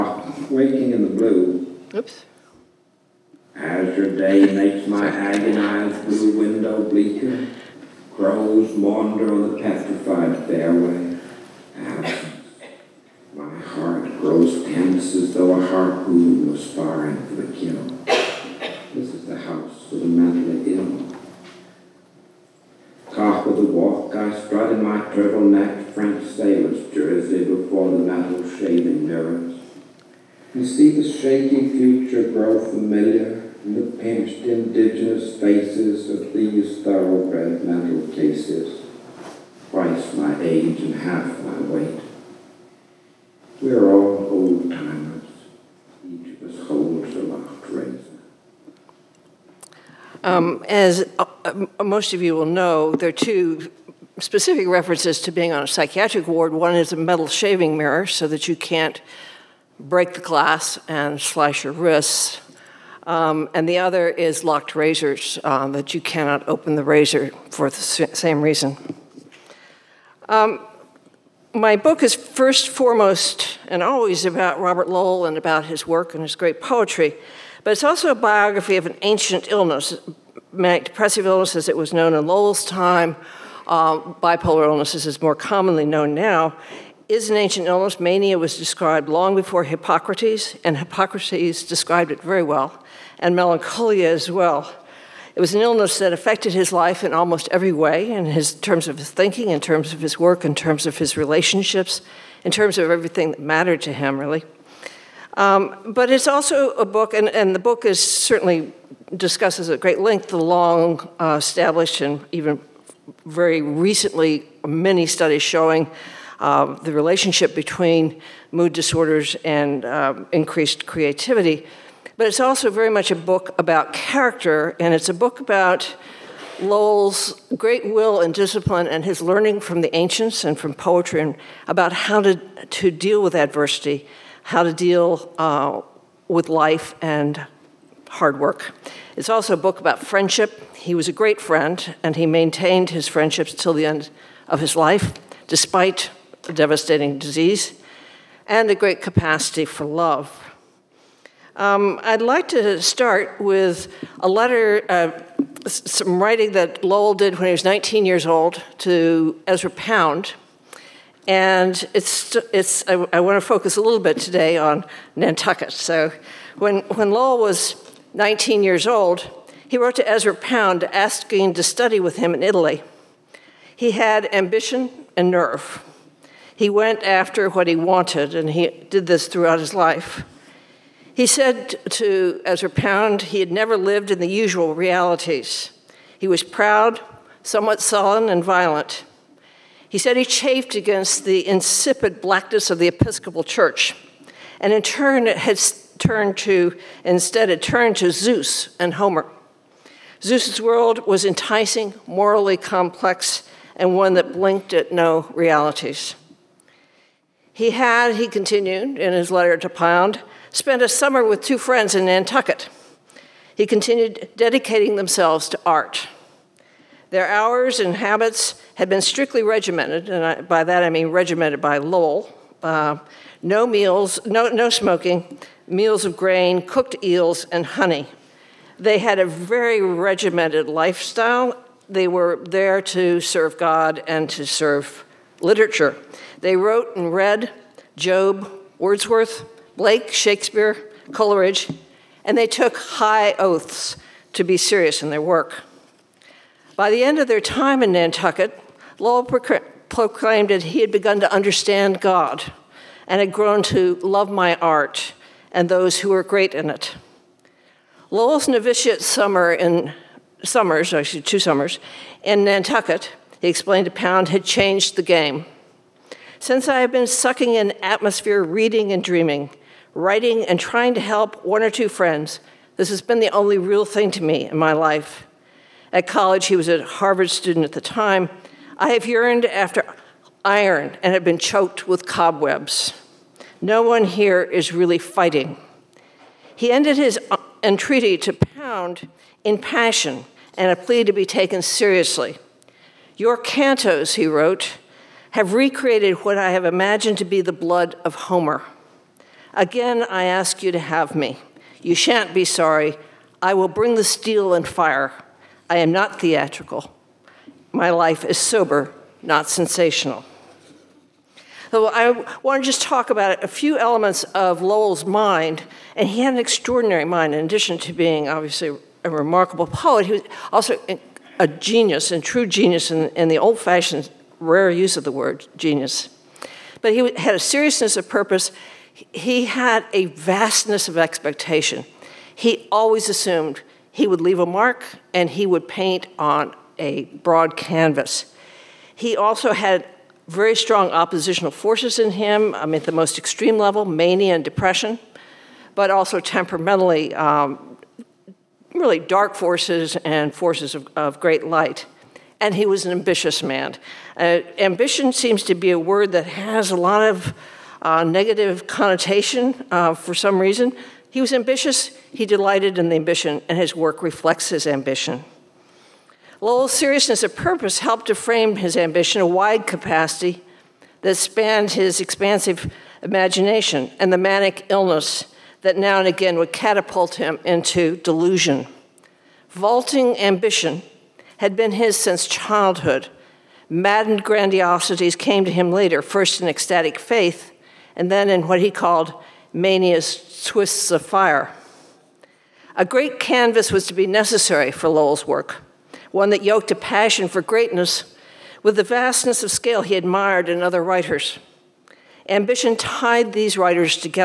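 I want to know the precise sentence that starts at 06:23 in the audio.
Maddened grandiosities came to him later, first in ecstatic faith, and then in what he called mania's twists of fire.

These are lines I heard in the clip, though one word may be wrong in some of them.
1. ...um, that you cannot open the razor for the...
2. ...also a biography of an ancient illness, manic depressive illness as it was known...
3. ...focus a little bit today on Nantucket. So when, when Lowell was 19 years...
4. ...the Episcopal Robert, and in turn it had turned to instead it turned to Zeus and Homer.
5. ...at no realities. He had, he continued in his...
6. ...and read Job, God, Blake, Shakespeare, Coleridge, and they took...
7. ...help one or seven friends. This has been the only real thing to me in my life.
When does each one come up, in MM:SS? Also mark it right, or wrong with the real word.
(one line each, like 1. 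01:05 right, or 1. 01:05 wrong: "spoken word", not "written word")
1. 01:05 right
2. 01:17 right
3. 02:43 right
4. 03:12 wrong: "Church", not "Robert"
5. 03:24 right
6. 03:56 wrong: "Wordsworth", not "God"
7. 04:31 wrong: "two", not "seven".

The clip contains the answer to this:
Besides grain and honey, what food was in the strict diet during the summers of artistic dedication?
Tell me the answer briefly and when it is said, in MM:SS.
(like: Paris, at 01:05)
Cooked eels, at 03:46.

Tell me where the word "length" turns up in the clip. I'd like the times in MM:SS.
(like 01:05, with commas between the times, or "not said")
01:49.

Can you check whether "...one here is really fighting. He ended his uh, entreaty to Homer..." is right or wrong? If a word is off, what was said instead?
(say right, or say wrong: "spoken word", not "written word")
wrong: "Pound", not "Homer".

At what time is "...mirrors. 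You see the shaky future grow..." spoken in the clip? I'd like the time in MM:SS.
00:29.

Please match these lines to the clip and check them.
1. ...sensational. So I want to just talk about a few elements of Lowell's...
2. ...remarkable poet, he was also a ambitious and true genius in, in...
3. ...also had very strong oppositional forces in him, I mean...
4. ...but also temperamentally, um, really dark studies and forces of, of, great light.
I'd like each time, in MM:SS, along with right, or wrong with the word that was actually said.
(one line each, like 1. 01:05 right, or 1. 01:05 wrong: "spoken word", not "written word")
1. 05:09 right
2. 05:19 wrong: "genius", not "ambitious"
3. 05:39 right
4. 05:45 wrong: "forces", not "studies".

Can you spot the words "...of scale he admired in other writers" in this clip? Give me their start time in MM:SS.
06:39.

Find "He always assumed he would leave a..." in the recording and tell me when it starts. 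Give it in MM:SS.
05:32.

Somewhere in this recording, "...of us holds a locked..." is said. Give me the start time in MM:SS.
00:46.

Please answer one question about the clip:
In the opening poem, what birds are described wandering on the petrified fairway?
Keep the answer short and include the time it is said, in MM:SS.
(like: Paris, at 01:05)
Crows, at 00:08.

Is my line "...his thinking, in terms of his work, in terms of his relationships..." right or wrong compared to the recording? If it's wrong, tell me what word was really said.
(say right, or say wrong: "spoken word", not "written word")
right.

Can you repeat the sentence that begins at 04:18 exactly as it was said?
Lowell's novitiate summer in summers, actually two summers, in Nantucket, he explained to Pound, had changed the game.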